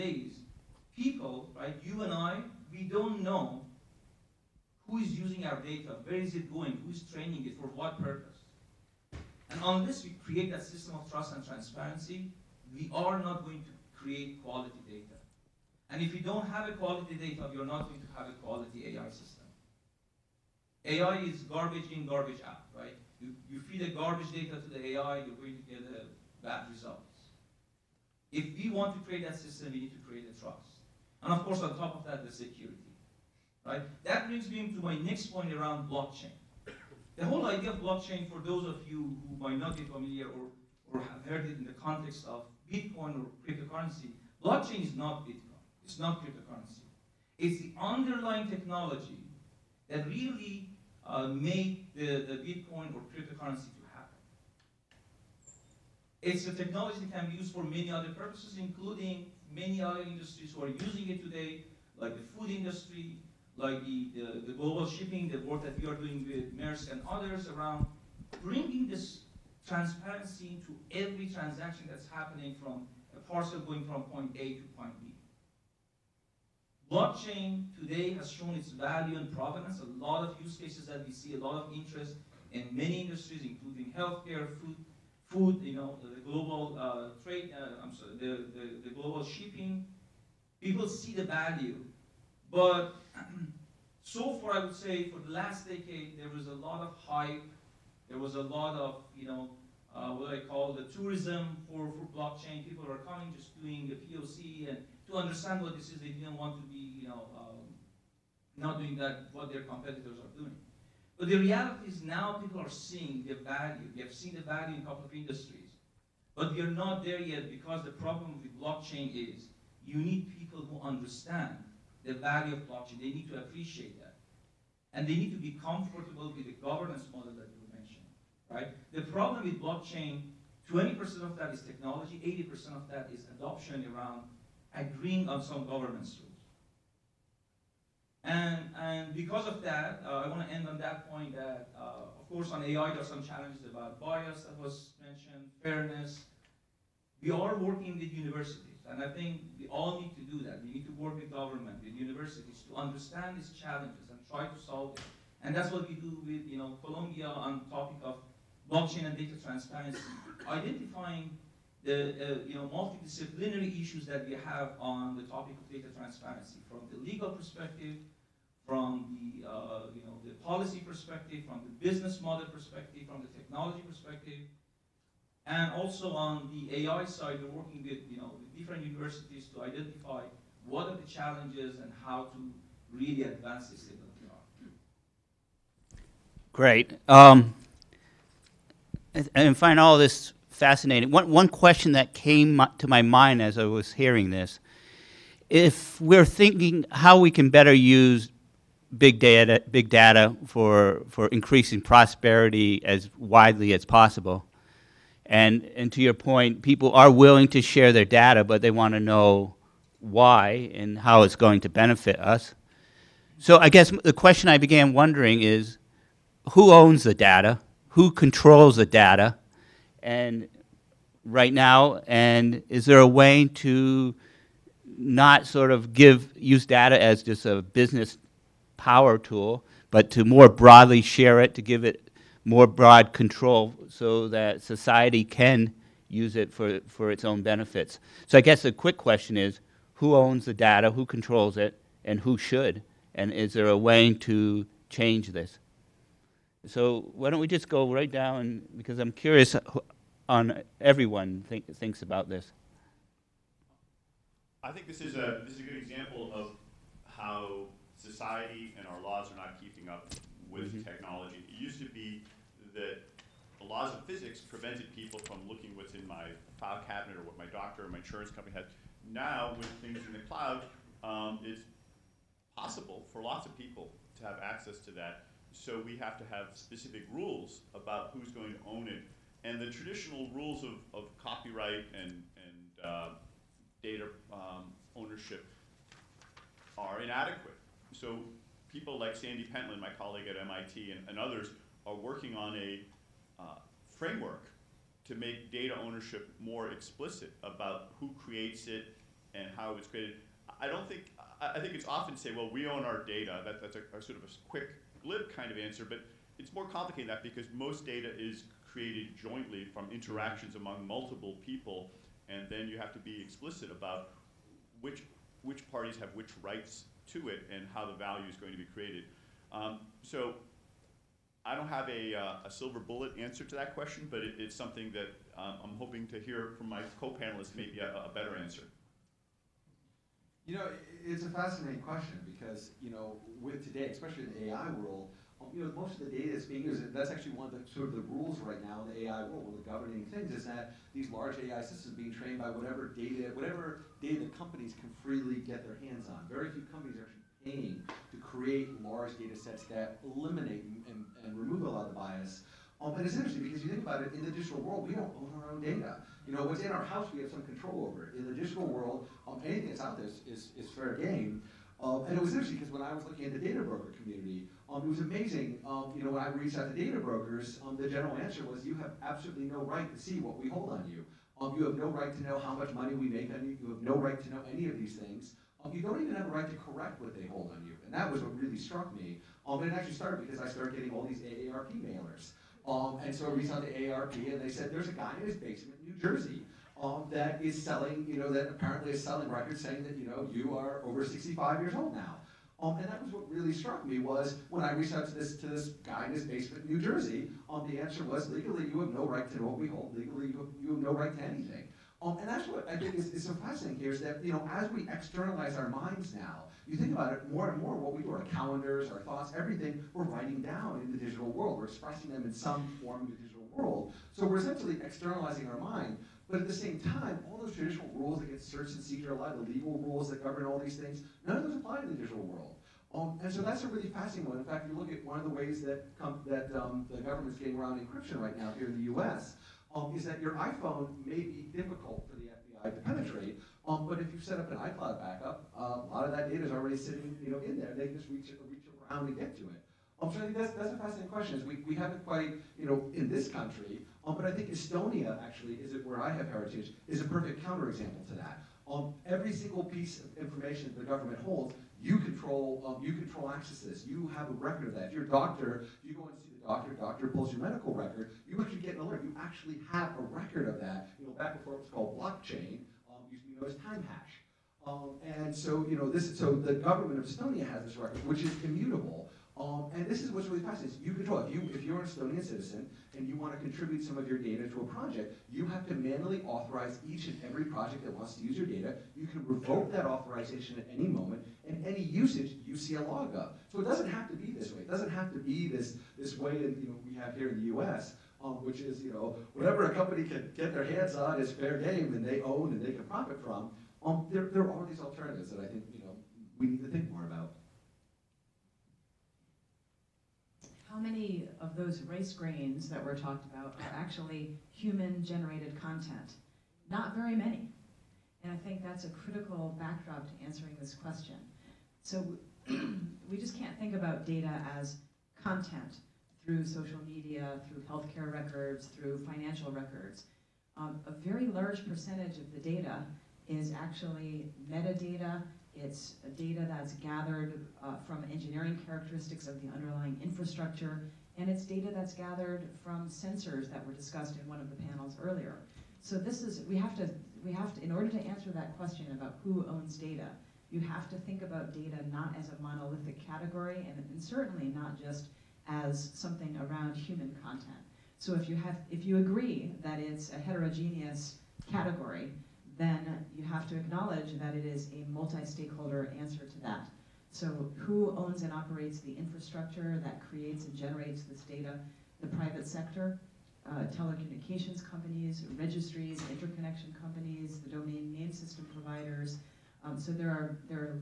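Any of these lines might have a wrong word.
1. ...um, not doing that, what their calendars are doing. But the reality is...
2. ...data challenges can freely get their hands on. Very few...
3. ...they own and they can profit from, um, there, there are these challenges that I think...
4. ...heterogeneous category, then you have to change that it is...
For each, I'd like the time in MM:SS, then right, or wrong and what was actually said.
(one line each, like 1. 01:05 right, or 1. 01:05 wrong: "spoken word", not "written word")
1. 01:47 wrong: "competitors", not "calendars"
2. 05:44 wrong: "companies", not "challenges"
3. 08:12 wrong: "alternatives", not "challenges"
4. 09:10 wrong: "acknowledge", not "change".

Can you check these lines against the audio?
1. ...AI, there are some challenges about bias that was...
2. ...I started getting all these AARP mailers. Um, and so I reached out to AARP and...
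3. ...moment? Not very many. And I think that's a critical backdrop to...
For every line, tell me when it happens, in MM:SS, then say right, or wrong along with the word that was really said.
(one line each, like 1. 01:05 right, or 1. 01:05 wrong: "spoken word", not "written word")
1. 02:22 right
2. 06:20 right
3. 08:25 wrong: "content", not "moment".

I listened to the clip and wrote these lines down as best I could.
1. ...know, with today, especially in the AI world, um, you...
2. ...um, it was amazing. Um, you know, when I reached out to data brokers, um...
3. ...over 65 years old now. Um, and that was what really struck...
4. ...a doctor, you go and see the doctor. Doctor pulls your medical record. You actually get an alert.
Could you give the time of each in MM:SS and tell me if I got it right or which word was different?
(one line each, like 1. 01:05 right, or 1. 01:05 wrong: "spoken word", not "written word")
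1. 05:32 right
2. 06:04 right
3. 06:30 right
4. 07:35 right.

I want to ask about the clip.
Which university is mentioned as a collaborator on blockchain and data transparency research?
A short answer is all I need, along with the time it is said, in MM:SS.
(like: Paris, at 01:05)
Columbia, at 02:36.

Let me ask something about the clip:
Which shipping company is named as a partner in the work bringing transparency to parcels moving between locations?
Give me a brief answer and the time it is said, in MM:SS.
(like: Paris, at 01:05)
Maersk, at 01:06.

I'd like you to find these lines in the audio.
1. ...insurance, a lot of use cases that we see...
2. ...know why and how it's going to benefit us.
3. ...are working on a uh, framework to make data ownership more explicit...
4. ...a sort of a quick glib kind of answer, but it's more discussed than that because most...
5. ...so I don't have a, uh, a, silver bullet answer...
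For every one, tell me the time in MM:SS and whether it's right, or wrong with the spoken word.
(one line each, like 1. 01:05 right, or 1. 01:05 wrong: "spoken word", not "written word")
1. 01:19 wrong: "provenance", not "insurance"
2. 03:29 right
3. 04:51 right
4. 05:03 wrong: "complicated", not "discussed"
5. 05:20 right.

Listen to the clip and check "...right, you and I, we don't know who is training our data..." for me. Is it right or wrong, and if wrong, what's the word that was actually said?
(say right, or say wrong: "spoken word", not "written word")
wrong: "using", not "training".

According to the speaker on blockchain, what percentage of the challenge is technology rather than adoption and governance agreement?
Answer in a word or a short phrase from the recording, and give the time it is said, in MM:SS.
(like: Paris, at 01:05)
20%, at 02:10.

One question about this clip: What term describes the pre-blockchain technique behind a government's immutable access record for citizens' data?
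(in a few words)
time hash.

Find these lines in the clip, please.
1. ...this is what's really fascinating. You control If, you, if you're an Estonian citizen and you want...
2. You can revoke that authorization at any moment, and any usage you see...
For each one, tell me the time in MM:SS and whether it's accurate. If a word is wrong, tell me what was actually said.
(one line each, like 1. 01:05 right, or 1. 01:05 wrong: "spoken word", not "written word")
1. 07:49 right
2. 07:58 right.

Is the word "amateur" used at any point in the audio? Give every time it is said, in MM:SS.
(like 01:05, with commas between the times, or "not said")
not said.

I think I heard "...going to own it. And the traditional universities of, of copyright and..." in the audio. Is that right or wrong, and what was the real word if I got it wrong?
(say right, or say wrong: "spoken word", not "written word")
wrong: "rules", not "universities".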